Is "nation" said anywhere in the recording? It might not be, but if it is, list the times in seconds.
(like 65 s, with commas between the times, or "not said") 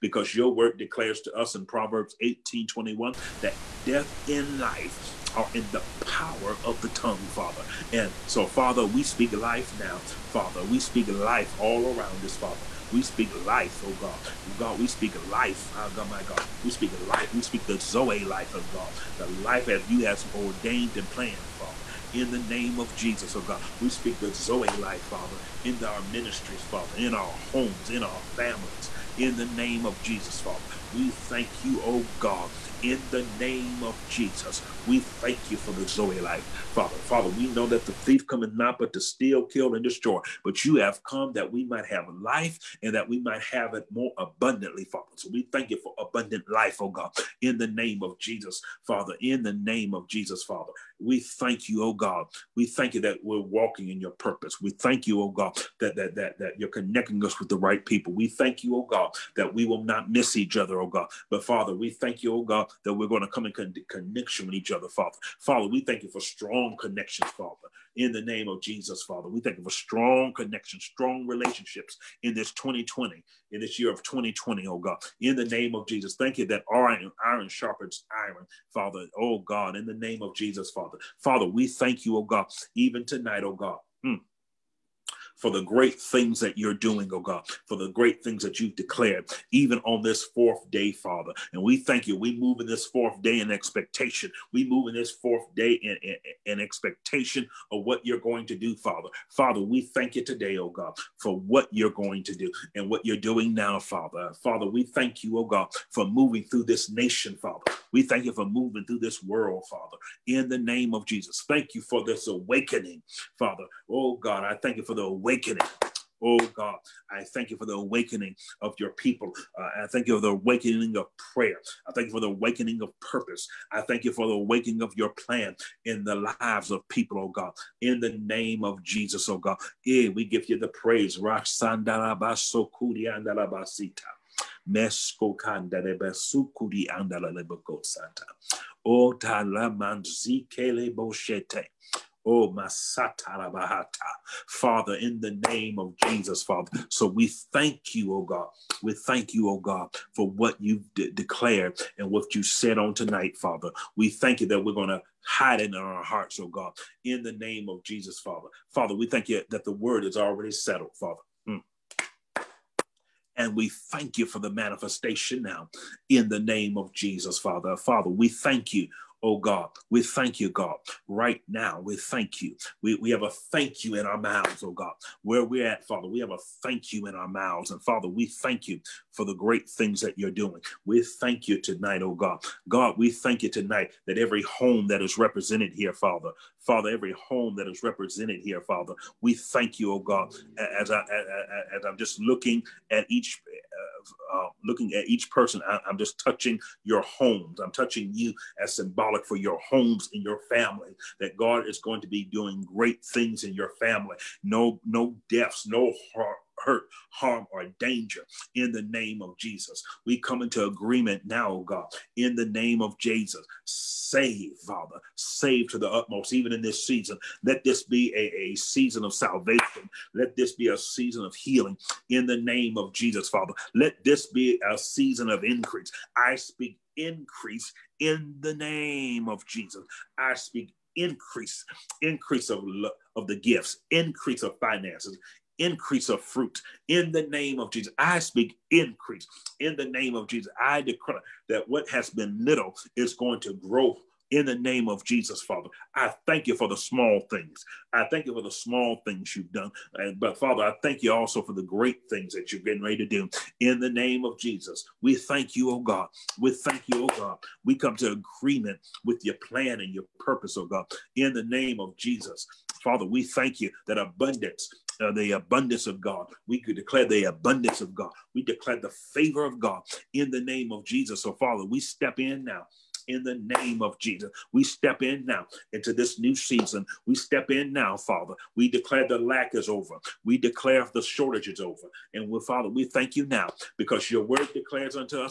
106 s.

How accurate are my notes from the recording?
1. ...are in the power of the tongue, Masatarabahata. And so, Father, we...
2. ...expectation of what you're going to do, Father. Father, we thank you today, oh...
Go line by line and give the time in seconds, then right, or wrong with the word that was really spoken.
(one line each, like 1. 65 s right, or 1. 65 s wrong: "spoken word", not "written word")
1. 5 s wrong: "Father", not "Masatarabahata"
2. 96 s right.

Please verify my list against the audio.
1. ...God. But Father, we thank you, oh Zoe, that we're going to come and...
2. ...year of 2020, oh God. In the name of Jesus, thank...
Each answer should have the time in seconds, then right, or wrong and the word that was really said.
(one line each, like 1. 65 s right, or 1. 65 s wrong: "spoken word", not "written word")
1. 60 s wrong: "God", not "Zoe"
2. 73 s right.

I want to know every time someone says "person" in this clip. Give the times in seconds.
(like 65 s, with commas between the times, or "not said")
195 s.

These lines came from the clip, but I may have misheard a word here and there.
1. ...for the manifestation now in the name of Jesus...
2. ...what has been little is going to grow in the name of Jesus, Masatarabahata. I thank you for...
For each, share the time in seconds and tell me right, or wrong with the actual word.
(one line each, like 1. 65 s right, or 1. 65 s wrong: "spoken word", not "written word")
1. 164 s right
2. 241 s wrong: "Father", not "Masatarabahata".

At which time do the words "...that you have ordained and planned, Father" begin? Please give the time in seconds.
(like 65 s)
19 s.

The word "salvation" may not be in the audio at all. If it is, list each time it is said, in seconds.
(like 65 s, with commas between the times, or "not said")
219 s.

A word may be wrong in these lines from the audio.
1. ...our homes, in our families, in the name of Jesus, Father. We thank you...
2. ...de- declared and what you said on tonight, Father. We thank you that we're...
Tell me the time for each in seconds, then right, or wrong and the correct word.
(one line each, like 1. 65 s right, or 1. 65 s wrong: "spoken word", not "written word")
1. 27 s right
2. 150 s right.